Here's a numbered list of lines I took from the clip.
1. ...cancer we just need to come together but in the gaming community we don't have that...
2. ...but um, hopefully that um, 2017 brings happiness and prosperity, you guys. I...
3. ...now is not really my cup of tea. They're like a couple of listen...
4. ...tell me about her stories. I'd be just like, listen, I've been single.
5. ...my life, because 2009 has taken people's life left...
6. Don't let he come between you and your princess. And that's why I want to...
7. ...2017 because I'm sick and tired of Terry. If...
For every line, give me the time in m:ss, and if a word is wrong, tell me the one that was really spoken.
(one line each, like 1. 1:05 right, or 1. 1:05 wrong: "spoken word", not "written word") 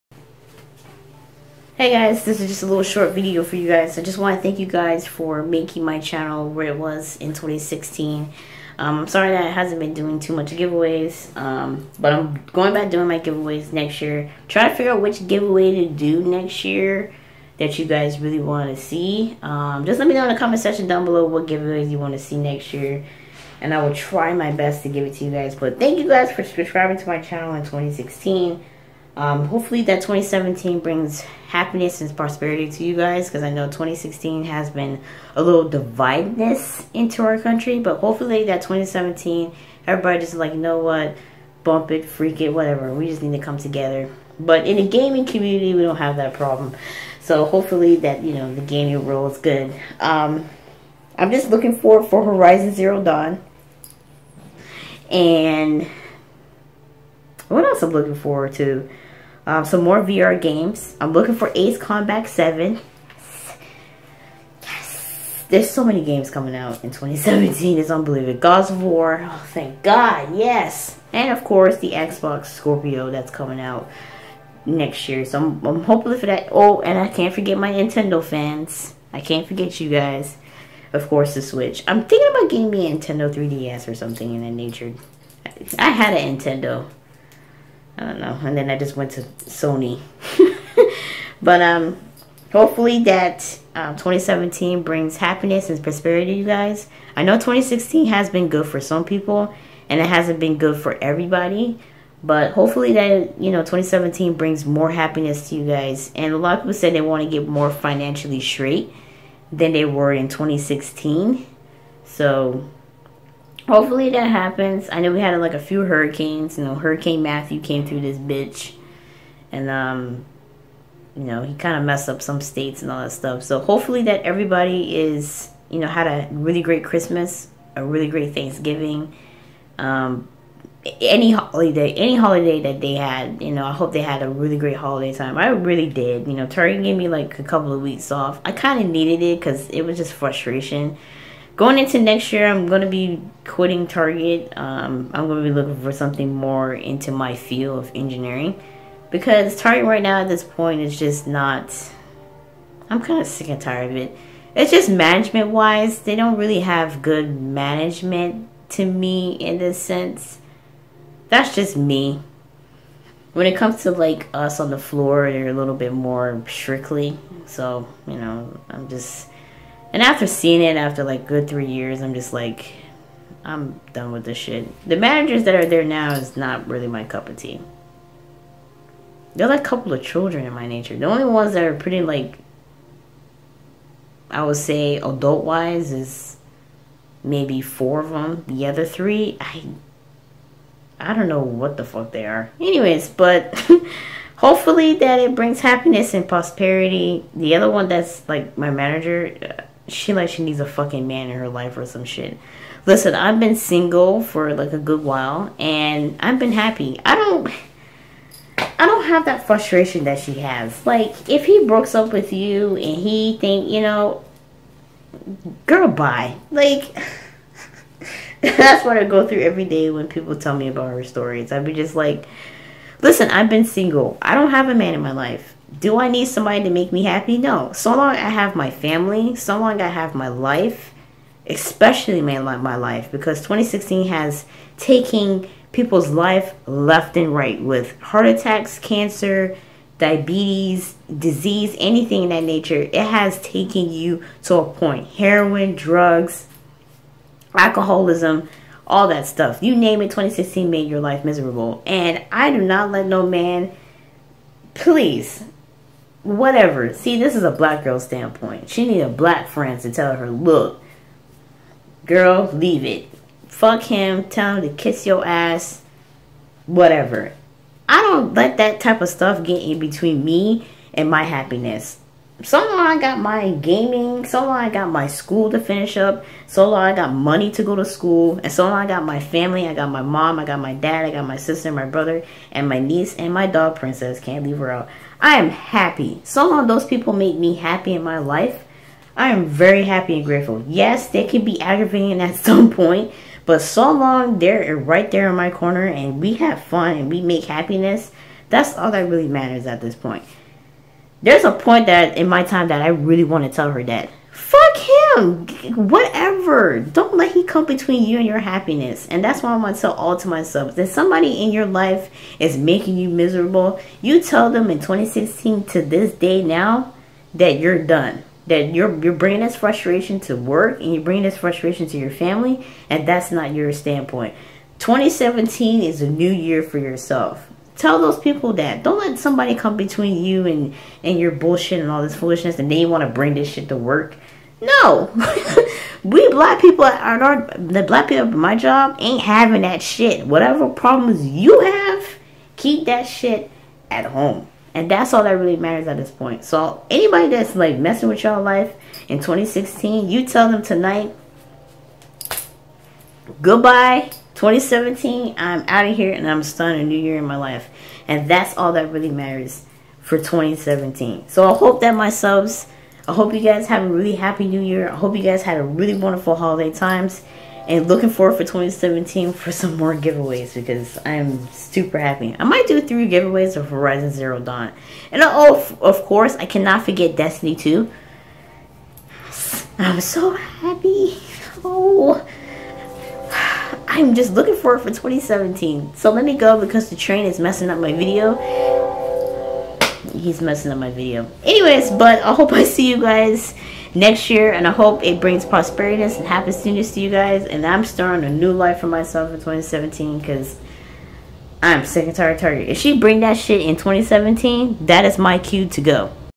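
1. 0:42 wrong: "whatever", not "cancer"
2. 1:31 right
3. 2:55 wrong: "children", not "listen"
4. 3:40 right
5. 3:52 wrong: "2016", not "2009"
6. 5:06 wrong: "happiness", not "princess"
7. 6:39 wrong: "Target", not "Terry".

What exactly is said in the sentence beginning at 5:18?
That you're, you're bringing this frustration to work and you're bringing this frustration to your family.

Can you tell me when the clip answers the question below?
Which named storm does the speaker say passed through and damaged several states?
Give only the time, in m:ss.
1:56.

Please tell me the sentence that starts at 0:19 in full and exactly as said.
Um, just let me know in the comment section down below what giveaways you want to see next year.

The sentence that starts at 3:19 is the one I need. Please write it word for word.
Uh, she like she needs a fucking man in her life or some shit.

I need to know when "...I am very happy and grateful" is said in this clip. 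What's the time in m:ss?
4:49.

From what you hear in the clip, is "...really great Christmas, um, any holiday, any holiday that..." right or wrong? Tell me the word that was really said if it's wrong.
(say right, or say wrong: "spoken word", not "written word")
wrong: "Thanksgiving", not "Christmas".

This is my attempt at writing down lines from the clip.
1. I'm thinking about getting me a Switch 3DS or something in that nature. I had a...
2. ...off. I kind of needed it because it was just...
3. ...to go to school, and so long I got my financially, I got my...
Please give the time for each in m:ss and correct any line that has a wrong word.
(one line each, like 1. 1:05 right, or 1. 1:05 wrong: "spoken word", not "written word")
1. 1:21 wrong: "Nintendo", not "Switch"
2. 2:18 right
3. 4:37 wrong: "family", not "financially".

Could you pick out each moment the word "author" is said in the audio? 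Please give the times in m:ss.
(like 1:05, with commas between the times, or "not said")
not said.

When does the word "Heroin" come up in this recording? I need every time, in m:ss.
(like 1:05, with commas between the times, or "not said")
4:05.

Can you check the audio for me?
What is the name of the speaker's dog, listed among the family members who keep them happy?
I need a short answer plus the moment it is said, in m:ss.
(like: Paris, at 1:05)
Princess, at 4:43.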